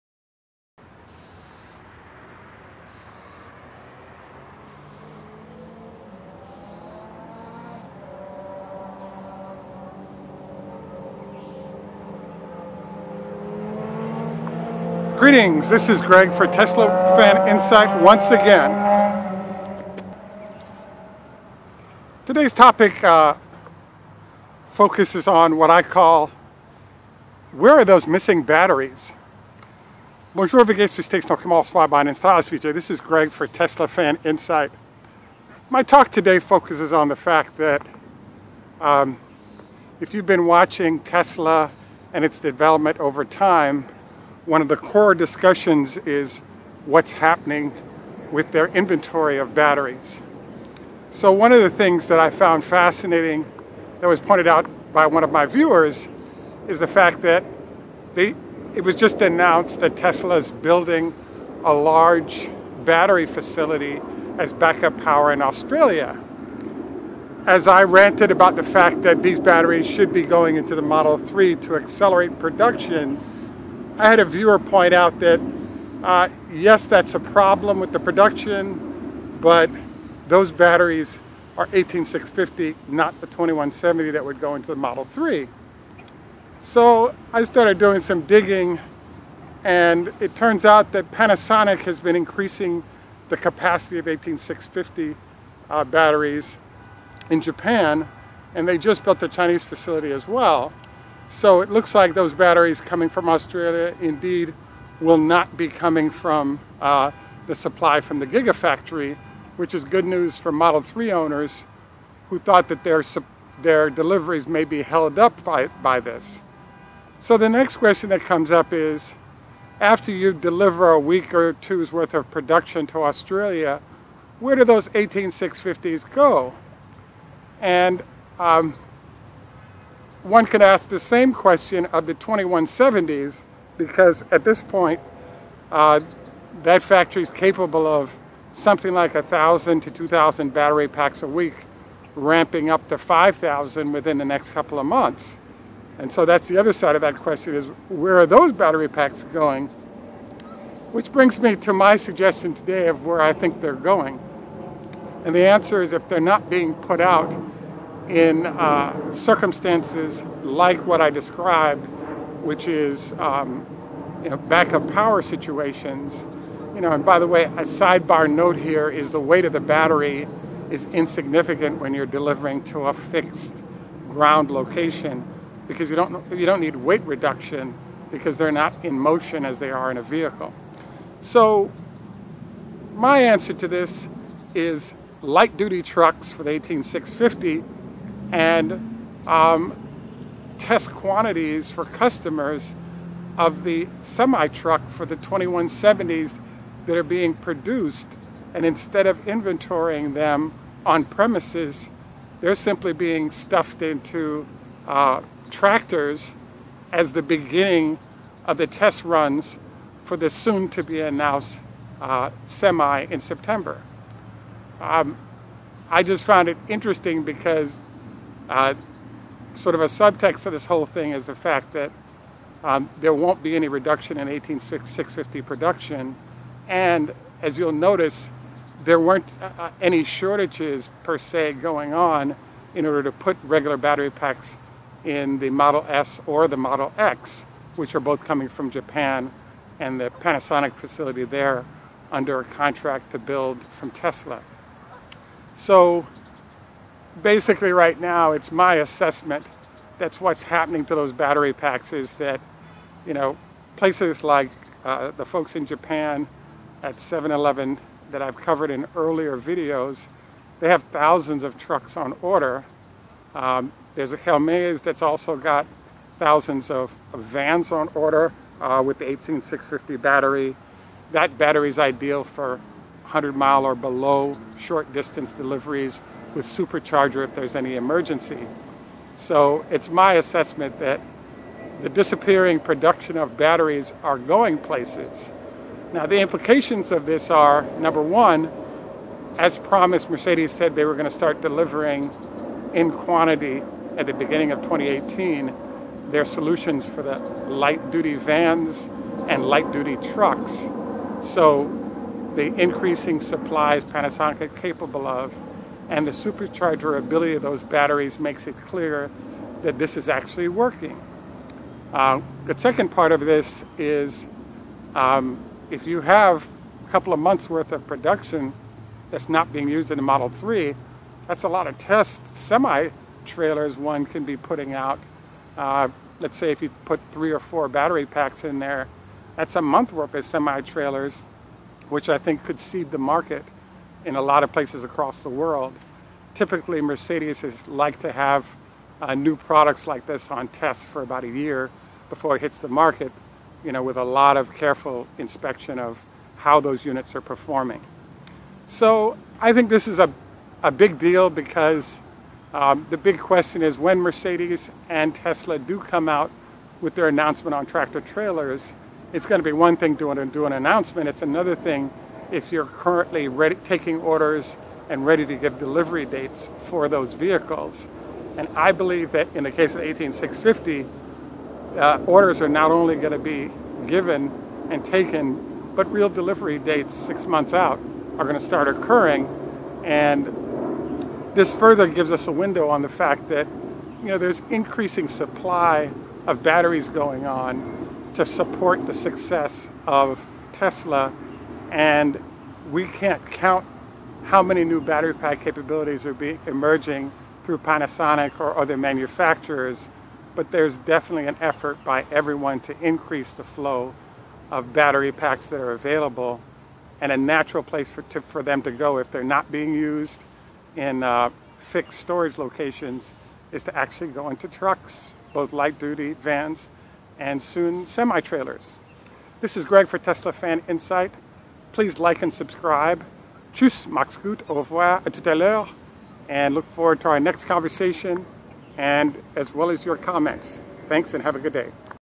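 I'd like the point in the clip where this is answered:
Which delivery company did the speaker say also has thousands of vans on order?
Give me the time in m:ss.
4:24.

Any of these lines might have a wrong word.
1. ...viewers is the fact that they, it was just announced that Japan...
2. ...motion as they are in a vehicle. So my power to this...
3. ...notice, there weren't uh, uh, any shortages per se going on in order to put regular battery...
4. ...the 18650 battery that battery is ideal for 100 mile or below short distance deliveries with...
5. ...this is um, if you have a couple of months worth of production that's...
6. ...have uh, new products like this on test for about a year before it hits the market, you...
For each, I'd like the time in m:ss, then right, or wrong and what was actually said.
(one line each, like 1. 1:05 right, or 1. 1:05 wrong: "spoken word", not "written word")
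1. 0:55 wrong: "Tesla", not "Japan"
2. 2:58 wrong: "answer", not "power"
3. 3:47 right
4. 4:28 right
5. 5:13 right
6. 5:38 right.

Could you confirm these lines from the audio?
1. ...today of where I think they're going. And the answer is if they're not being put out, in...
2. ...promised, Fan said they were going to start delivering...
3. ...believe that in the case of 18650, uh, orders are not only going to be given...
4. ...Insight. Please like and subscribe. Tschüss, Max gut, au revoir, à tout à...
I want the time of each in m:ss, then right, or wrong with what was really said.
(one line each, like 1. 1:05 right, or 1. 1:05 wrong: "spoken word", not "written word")
1. 2:32 right
2. 4:49 wrong: "Mercedes", not "Fan"
3. 6:08 right
4. 7:00 right.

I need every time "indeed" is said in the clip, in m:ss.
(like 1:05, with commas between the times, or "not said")
1:44.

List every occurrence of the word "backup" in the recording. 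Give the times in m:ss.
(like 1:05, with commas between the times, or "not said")
1:04, 2:44.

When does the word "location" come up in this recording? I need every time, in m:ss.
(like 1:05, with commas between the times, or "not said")
2:54, 6:52.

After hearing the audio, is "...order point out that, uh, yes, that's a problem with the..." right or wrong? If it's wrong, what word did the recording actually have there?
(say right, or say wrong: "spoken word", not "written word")
wrong: "viewer", not "order".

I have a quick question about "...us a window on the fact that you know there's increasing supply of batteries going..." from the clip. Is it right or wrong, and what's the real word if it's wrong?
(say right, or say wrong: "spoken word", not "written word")
right.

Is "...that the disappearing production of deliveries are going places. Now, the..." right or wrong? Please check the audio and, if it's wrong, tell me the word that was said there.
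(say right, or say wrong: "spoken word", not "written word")
wrong: "batteries", not "deliveries".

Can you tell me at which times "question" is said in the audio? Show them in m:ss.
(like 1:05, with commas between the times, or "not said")
1:57, 2:11, 2:27, 5:53.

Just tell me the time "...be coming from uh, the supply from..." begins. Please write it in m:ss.
1:45.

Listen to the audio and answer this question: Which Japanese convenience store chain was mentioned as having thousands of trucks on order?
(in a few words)
7-Eleven.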